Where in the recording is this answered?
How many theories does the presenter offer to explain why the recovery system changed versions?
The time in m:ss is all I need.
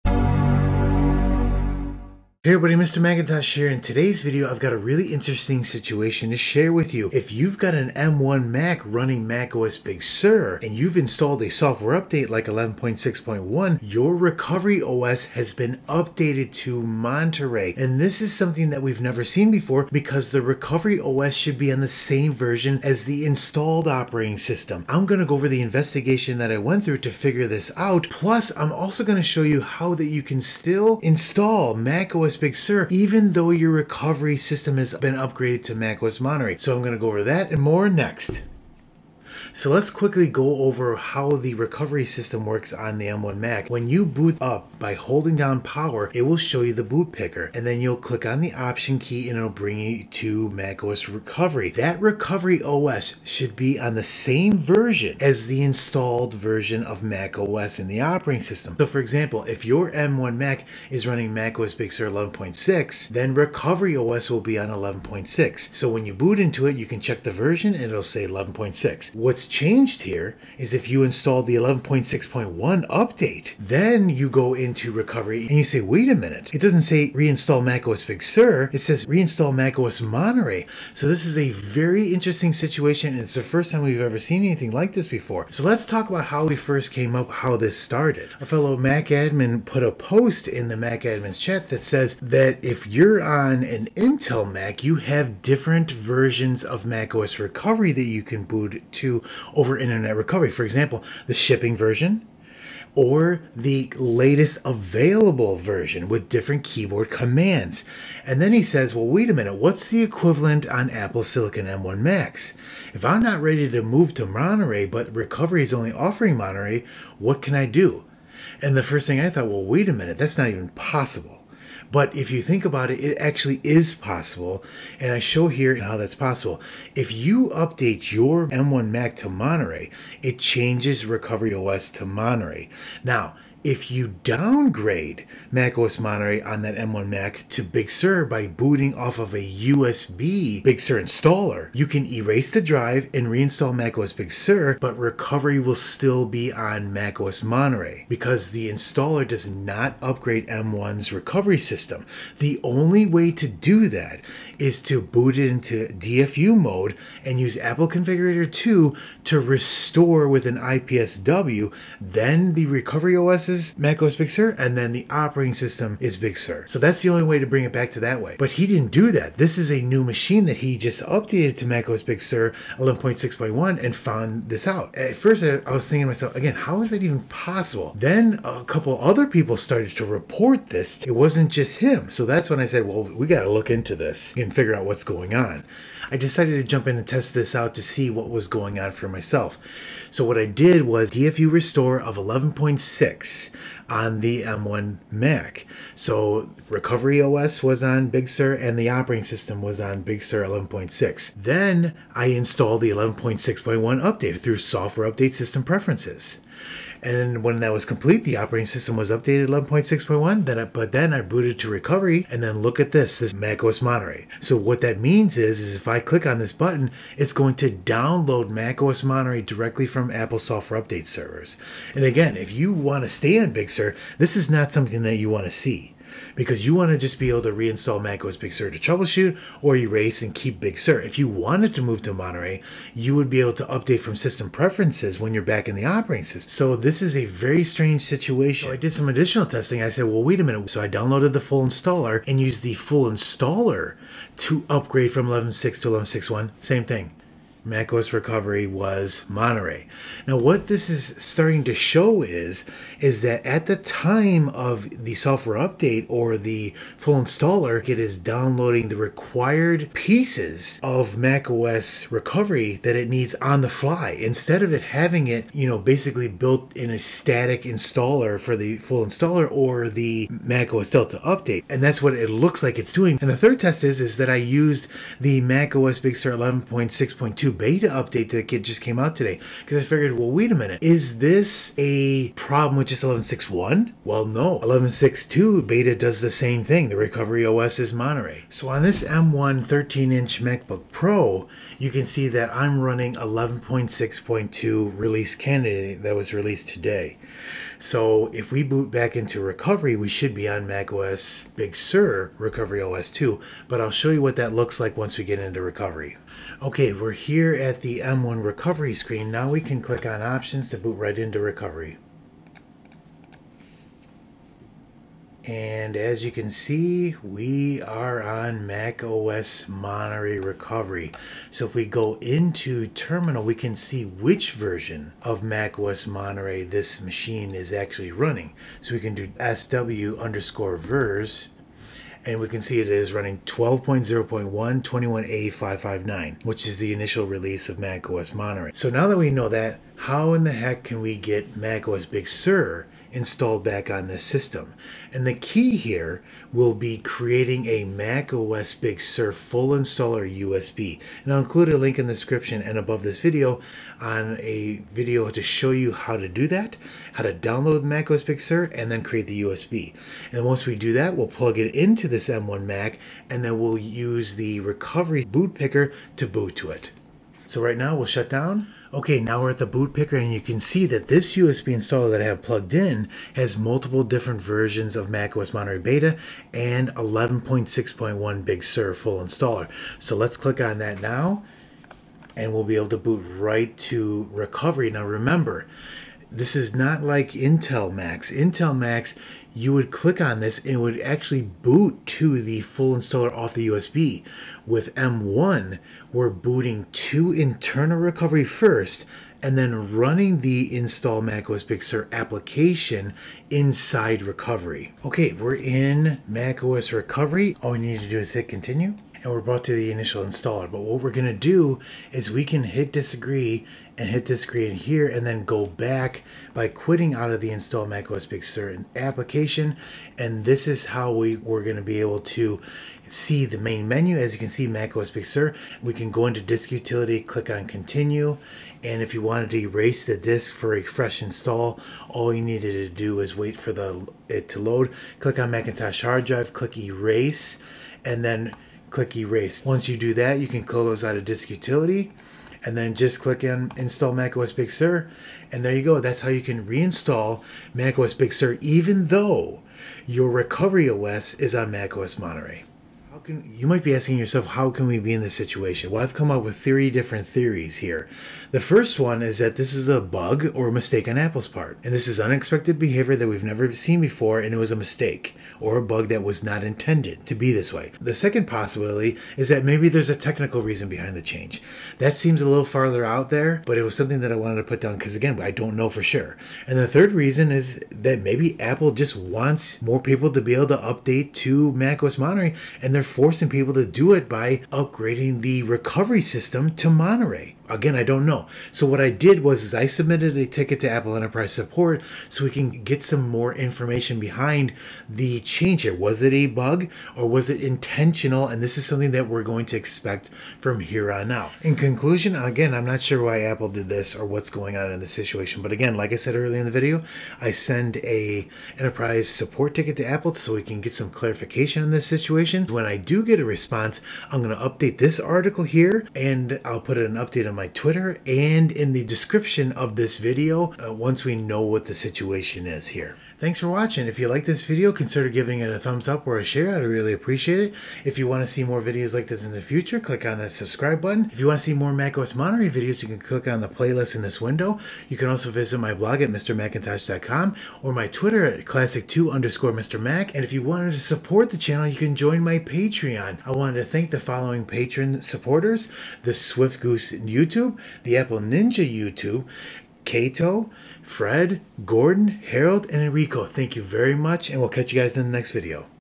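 7:36.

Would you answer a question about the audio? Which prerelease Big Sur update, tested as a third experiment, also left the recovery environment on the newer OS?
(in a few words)
11.6.2 beta.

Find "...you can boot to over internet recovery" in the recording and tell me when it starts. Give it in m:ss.
1:38.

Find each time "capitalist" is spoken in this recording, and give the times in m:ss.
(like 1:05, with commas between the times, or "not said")
not said.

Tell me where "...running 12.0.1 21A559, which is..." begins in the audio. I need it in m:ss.
5:33.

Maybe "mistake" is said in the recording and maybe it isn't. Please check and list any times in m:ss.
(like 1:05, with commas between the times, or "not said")
7:40, 7:44.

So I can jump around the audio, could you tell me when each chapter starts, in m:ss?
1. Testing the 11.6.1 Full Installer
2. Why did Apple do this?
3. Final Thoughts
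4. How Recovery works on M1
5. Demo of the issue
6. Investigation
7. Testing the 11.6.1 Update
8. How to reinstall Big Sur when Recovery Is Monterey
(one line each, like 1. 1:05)
1. 4:00
2. 7:34
3. 8:22
4. 0:39
5. 4:49
6. 1:26
7. 3:08
8. 5:40.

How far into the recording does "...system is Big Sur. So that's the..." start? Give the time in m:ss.
2:45.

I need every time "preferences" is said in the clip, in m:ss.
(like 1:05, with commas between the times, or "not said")
3:25, 3:54.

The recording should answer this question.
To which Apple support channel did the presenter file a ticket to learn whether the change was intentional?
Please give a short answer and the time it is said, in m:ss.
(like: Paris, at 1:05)
Apple Enterprise Support, at 8:10.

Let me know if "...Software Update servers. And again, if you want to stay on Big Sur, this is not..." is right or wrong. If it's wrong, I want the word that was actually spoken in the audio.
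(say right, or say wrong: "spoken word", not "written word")
right.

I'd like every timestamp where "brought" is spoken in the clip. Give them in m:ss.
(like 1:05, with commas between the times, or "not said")
6:49.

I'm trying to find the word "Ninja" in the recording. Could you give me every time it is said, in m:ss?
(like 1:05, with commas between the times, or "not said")
9:08.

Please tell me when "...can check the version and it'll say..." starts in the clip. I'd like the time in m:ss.
1:06.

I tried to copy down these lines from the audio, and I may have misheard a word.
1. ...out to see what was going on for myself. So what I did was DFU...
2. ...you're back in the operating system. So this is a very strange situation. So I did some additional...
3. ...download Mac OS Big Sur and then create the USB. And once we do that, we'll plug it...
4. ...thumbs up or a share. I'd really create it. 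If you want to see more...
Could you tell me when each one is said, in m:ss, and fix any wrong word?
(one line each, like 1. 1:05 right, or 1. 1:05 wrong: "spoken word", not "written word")
1. 3:07 right
2. 3:55 right
3. 5:57 right
4. 8:45 wrong: "appreciate", not "create".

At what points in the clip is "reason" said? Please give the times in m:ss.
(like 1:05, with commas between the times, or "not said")
7:50, 7:57.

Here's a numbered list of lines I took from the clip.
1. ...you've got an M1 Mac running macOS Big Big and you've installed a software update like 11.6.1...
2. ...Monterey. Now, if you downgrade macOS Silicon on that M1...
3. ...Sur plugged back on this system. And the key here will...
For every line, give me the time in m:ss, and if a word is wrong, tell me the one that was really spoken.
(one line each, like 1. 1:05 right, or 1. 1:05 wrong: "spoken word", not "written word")
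1. 0:07 wrong: "Sur", not "Big"
2. 2:12 wrong: "Monterey", not "Silicon"
3. 5:42 wrong: "installed", not "plugged".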